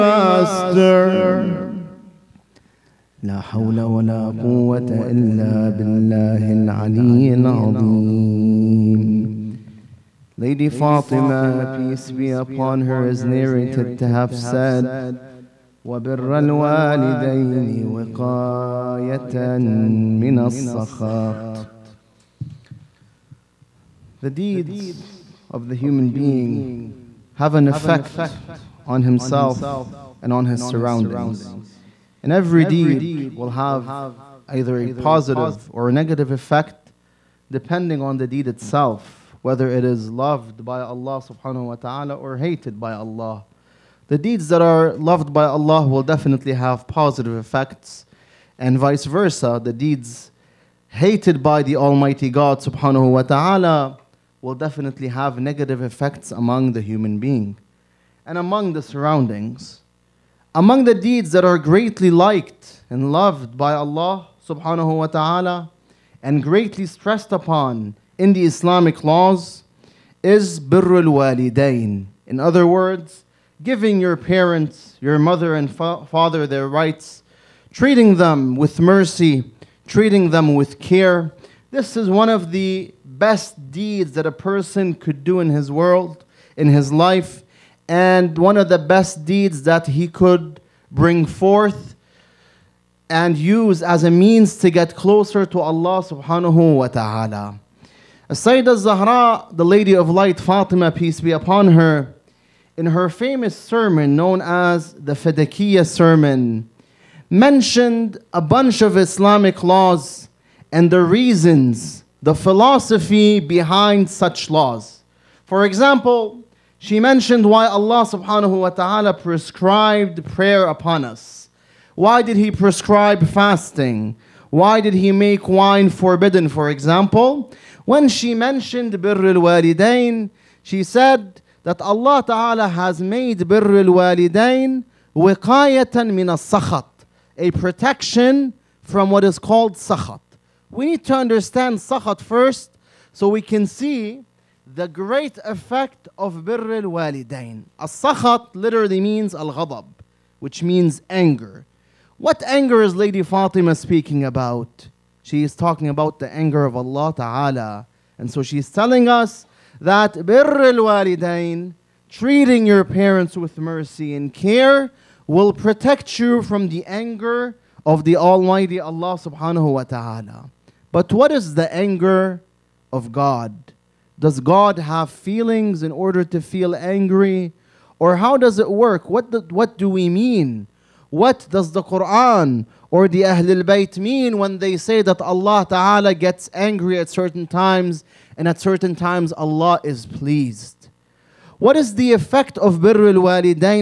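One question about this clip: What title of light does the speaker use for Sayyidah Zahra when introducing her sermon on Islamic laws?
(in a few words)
Lady of Light.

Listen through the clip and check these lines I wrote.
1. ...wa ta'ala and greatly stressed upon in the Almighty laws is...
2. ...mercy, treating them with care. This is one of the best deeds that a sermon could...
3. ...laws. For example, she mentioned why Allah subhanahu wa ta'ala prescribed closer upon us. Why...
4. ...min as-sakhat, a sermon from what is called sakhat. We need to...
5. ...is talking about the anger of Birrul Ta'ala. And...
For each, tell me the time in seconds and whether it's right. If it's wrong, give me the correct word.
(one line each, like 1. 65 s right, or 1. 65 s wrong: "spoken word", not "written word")
1. 64 s wrong: "Islamic", not "Almighty"
2. 78 s wrong: "person", not "sermon"
3. 114 s wrong: "prayer", not "closer"
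4. 136 s wrong: "protection", not "sermon"
5. 155 s wrong: "Allah", not "Birrul".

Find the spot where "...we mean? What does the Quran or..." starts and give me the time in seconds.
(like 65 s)
179 s.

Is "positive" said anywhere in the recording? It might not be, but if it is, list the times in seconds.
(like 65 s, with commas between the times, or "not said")
34 s, 46 s.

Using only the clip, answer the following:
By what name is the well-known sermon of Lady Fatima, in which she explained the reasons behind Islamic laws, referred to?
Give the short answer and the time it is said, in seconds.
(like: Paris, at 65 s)
Fadakiyah Sermon, at 105 s.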